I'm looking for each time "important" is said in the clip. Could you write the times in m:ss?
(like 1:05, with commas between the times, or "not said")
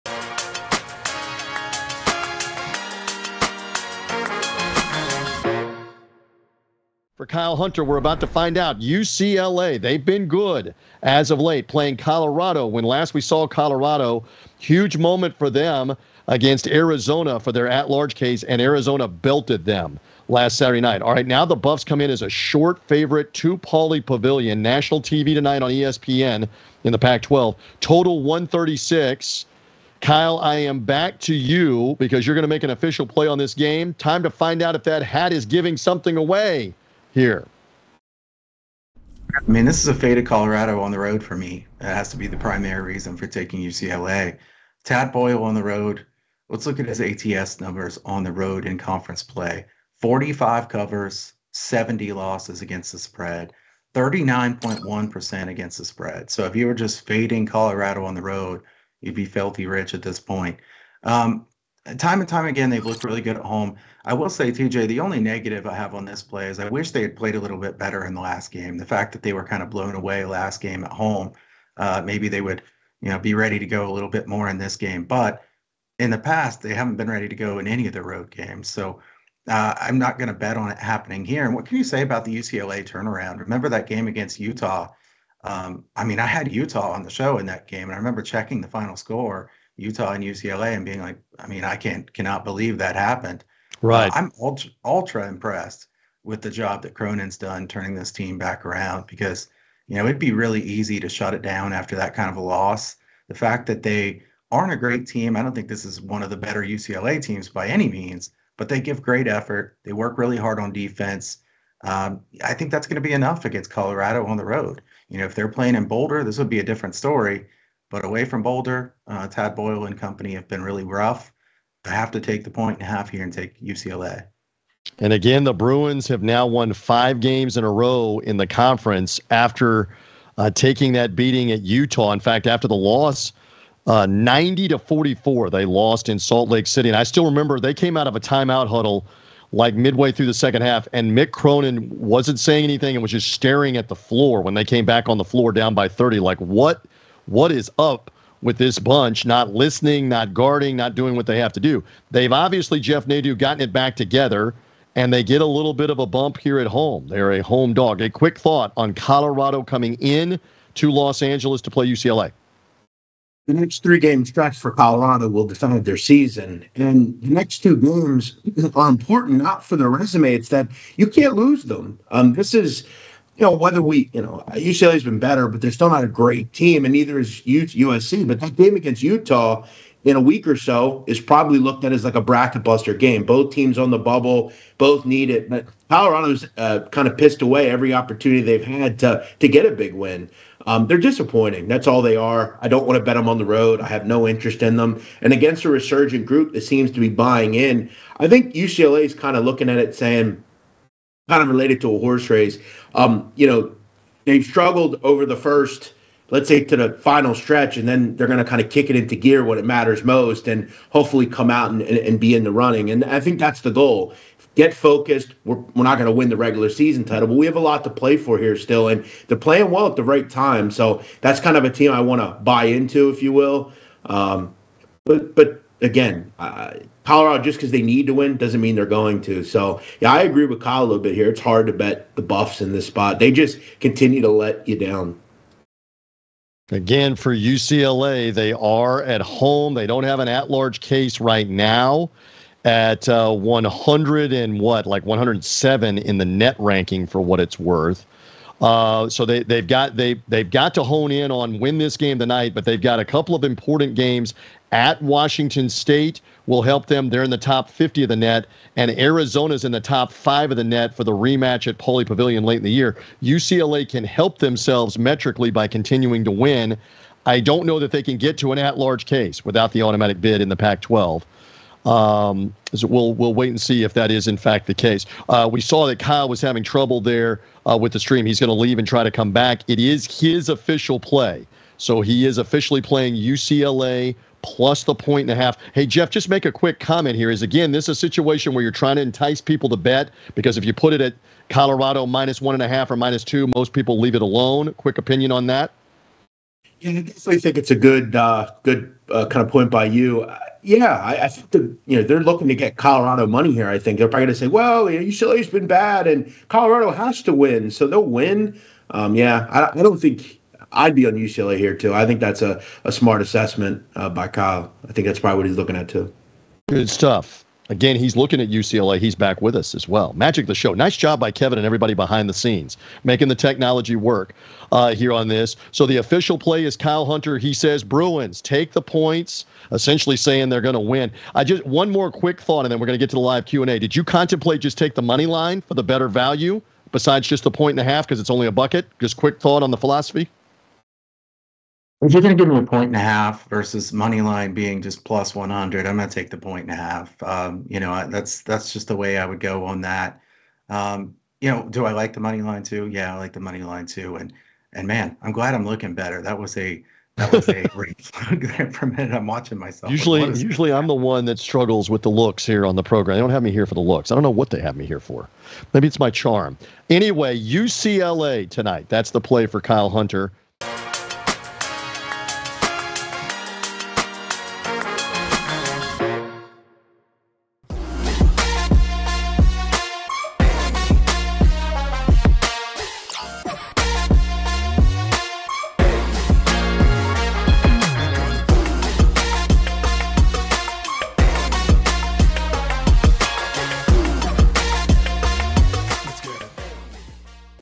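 2:48, 4:13.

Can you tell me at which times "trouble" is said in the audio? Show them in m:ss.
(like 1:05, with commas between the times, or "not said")
4:36.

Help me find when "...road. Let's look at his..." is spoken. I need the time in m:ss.
0:45.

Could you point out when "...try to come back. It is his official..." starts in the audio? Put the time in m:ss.
4:38.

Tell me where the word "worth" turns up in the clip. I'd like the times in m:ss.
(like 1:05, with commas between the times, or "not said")
4:07.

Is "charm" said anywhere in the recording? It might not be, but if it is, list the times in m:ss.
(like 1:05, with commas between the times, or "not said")
6:06.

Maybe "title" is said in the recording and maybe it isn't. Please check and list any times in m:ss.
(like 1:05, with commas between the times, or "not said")
3:37.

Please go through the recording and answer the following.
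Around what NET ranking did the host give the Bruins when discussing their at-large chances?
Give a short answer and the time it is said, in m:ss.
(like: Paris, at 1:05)
107, at 4:05.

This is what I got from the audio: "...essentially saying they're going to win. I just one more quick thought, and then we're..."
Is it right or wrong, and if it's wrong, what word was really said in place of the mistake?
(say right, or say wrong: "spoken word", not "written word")
right.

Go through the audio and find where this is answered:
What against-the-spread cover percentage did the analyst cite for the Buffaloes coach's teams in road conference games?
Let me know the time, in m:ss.
0:53.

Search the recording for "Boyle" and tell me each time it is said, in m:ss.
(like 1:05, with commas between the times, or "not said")
0:45, 1:59.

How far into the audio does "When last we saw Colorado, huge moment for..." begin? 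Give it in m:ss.
0:12.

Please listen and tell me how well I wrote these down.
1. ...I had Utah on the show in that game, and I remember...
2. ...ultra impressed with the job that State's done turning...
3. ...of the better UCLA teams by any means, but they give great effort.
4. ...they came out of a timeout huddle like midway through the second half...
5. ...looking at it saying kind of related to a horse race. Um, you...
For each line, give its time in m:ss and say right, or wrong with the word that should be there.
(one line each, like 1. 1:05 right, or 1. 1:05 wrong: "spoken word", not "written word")
1. 1:26 right
2. 1:34 wrong: "Cronin", not "State"
3. 1:46 right
4. 2:17 right
5. 3:19 right.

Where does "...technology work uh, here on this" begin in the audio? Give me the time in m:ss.
5:23.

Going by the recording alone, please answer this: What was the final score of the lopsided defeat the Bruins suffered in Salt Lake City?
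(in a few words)
90 to 44.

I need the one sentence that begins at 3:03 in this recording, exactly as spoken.
Both teams on the bubble, both need it.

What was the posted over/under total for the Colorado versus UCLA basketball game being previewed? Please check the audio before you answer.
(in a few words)
136.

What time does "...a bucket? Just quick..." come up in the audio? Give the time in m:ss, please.
5:38.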